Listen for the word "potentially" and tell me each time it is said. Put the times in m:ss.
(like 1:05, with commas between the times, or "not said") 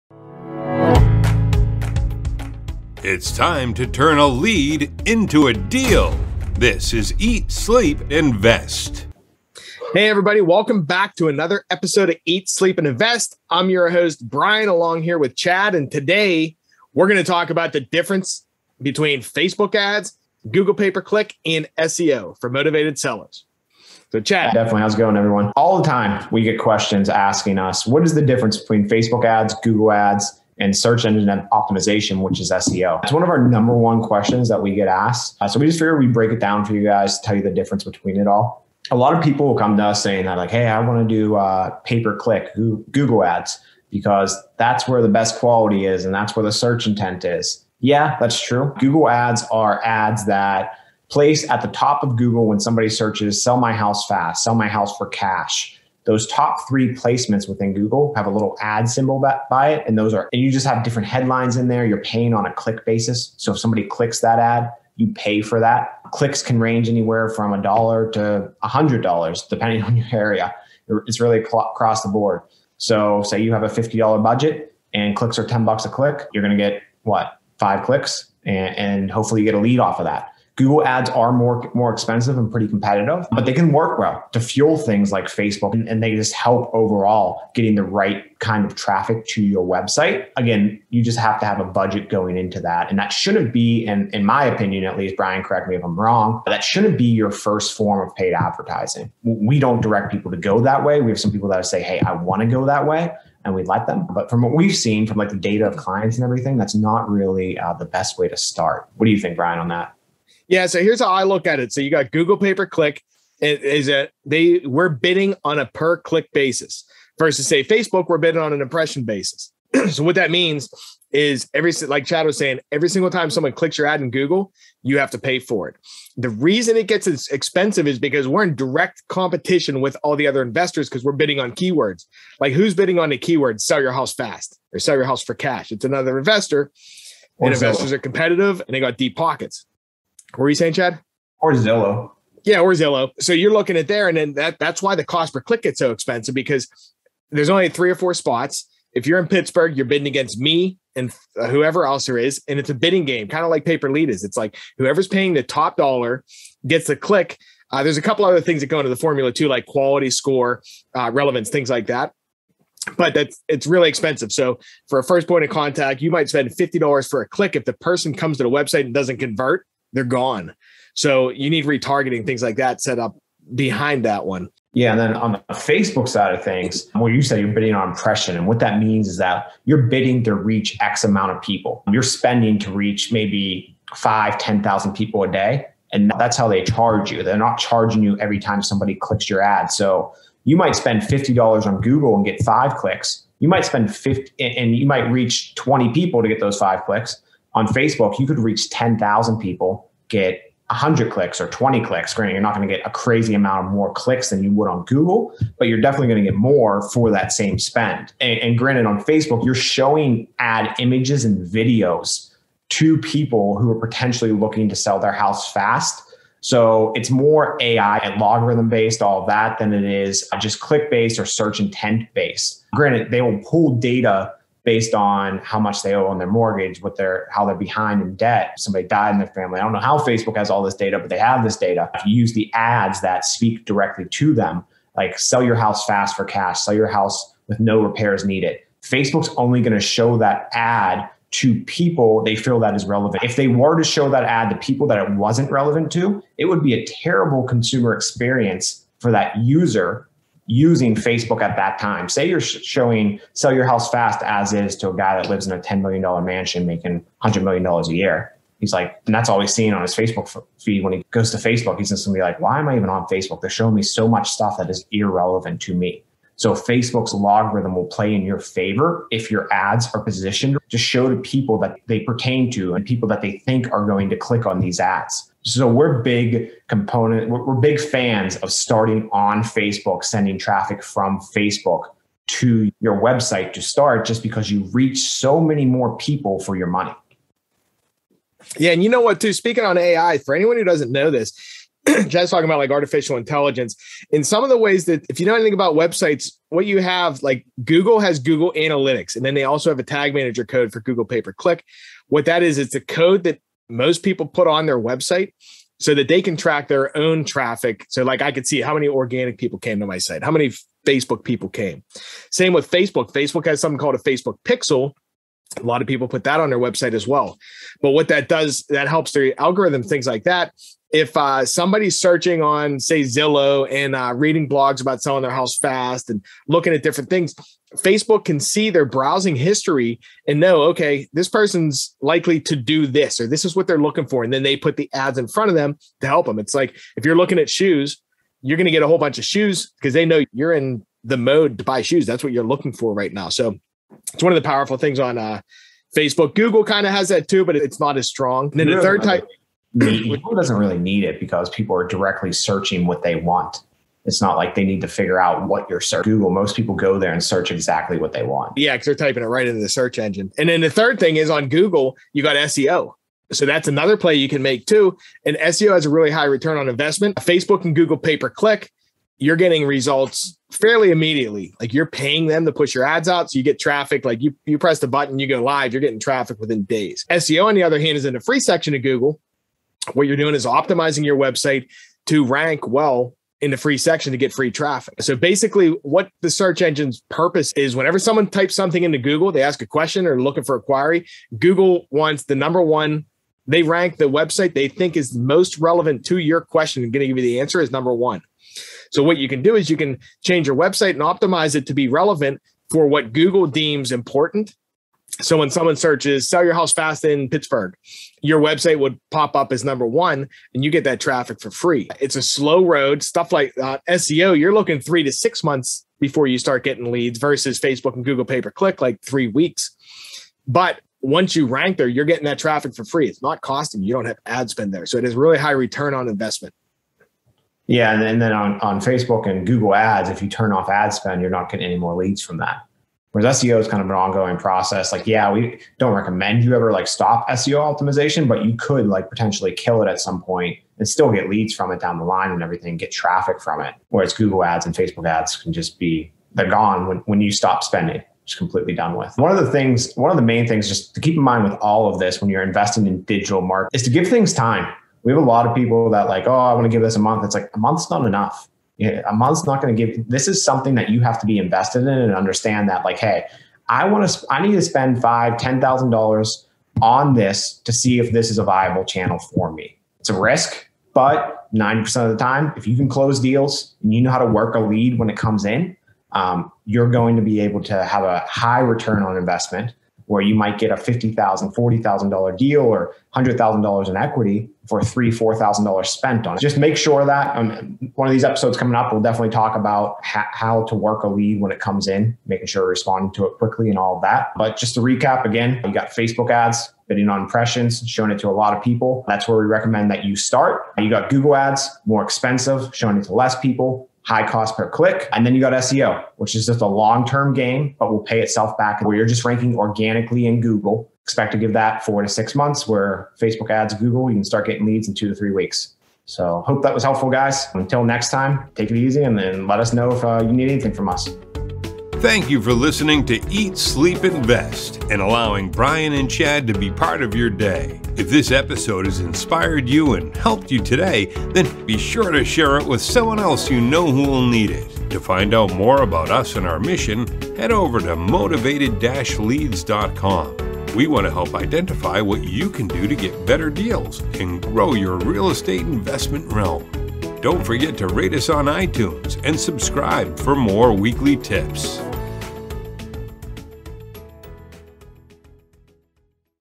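3:33, 7:19.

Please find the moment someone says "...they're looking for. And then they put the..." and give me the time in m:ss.
5:33.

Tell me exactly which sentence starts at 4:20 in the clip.
When he goes to Facebook, he's just gonna be like, why am I even on Facebook?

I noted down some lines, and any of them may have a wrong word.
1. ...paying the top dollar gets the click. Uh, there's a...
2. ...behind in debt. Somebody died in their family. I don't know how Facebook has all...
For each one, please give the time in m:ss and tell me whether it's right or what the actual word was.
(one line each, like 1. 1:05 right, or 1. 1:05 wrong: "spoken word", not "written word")
1. 2:35 right
2. 3:47 right.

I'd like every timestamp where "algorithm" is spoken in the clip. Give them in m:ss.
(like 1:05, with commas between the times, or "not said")
5:19.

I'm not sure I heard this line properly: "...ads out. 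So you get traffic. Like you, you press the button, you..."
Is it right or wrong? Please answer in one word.
right.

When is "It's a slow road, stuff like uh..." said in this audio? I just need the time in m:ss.
6:51.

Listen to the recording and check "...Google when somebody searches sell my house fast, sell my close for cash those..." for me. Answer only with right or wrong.
wrong.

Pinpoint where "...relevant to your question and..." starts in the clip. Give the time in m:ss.
6:35.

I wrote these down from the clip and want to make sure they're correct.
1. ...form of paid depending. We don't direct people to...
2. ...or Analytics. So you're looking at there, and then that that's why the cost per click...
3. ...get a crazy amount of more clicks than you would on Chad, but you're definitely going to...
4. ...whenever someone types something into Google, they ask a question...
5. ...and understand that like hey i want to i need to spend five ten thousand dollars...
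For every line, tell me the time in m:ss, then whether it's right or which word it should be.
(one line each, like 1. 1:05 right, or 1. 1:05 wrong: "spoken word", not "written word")
1. 1:37 wrong: "advertising", not "depending"
2. 2:22 wrong: "Zillow", not "Analytics"
3. 3:22 wrong: "Google", not "Chad"
4. 6:27 right
5. 7:41 right.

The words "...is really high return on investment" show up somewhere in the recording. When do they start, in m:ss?
7:05.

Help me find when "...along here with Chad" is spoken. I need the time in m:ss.
0:14.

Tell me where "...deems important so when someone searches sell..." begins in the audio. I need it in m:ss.
6:43.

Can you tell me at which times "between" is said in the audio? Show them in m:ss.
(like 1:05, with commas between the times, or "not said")
0:18, 0:28, 0:37.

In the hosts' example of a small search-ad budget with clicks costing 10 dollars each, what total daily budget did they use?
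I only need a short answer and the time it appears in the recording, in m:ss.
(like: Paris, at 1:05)
$50, at 1:13.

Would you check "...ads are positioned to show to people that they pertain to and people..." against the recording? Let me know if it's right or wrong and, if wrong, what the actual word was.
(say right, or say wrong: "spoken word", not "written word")
right.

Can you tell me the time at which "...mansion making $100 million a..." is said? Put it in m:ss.
4:16.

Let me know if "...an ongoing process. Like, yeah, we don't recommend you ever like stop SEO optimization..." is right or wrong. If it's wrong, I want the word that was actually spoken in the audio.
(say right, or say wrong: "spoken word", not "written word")
right.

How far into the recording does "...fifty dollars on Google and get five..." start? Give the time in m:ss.
3:11.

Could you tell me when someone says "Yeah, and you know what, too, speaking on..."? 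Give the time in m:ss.
4:48.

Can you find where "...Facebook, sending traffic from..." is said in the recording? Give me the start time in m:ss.
4:39.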